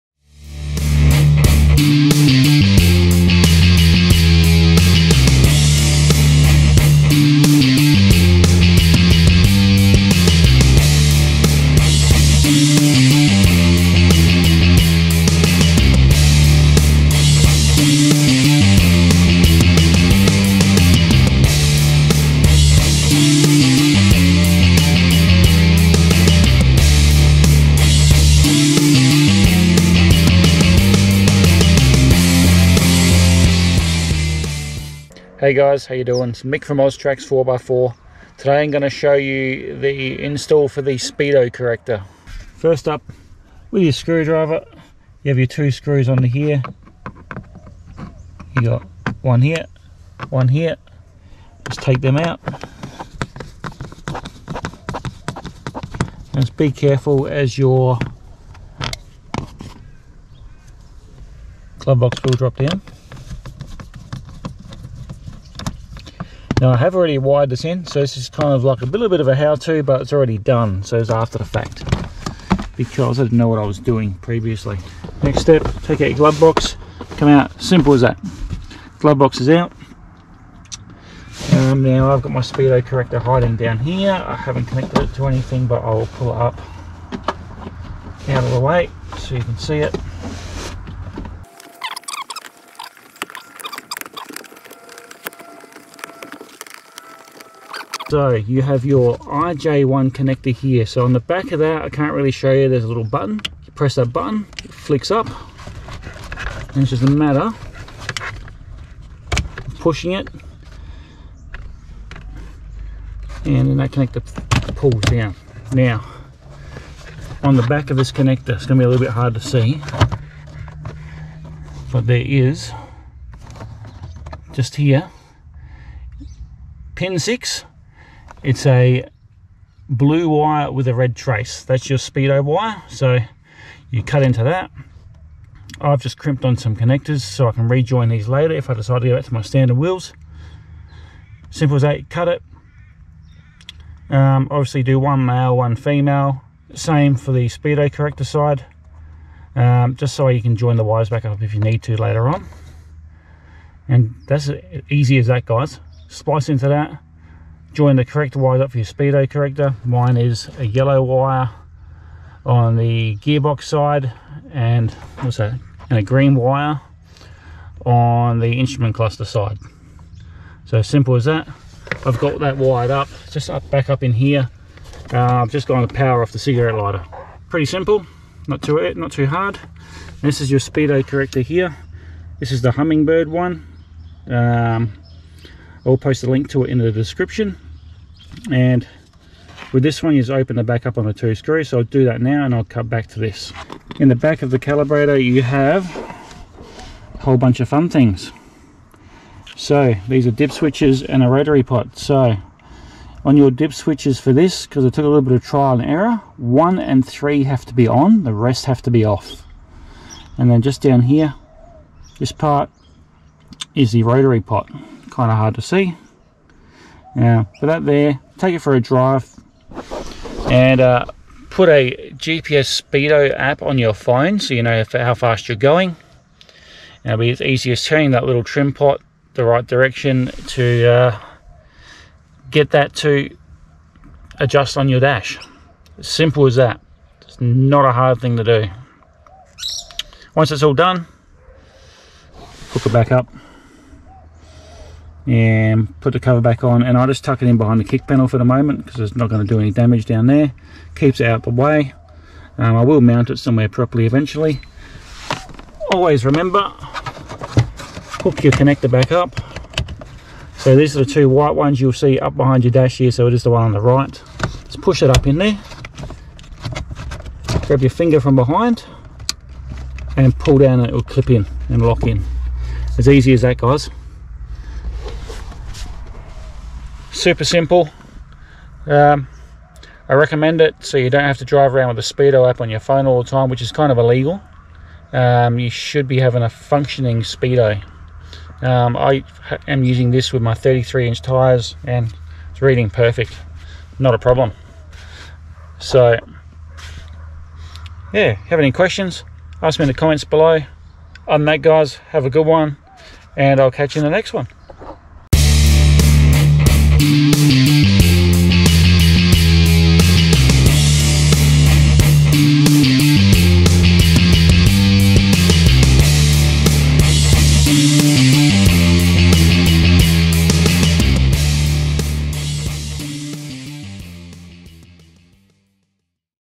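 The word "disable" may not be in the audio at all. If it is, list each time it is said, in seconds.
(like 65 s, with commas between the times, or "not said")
not said.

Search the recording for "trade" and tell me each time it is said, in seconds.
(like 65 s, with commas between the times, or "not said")
not said.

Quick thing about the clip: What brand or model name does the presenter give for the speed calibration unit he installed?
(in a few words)
Hummingbird.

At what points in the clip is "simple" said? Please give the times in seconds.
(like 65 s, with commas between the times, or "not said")
77 s, 141 s, 170 s, 177 s, 235 s, 277 s.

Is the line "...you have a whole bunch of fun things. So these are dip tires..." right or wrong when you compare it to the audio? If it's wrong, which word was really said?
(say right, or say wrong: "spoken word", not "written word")
wrong: "switches", not "tires".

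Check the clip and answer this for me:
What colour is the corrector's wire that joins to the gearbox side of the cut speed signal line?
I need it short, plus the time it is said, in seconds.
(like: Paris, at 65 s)
Yellow, at 160 s.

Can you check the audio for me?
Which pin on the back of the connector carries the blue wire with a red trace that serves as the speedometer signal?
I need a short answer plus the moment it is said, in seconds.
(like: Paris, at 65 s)
Pin 6, at 126 s.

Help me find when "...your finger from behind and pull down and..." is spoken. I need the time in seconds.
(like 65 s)
267 s.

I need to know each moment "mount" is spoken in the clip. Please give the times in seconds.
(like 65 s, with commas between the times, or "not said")
253 s.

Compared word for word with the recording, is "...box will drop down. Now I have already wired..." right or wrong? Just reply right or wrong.
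right.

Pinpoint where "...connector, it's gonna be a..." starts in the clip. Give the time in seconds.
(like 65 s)
118 s.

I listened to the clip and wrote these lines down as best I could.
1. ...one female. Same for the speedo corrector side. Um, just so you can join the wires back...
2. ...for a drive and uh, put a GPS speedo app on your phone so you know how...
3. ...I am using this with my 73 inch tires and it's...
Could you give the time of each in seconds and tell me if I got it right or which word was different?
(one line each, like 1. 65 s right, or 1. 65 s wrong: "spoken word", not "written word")
1. 145 s right
2. 218 s right
3. 288 s wrong: "33", not "73".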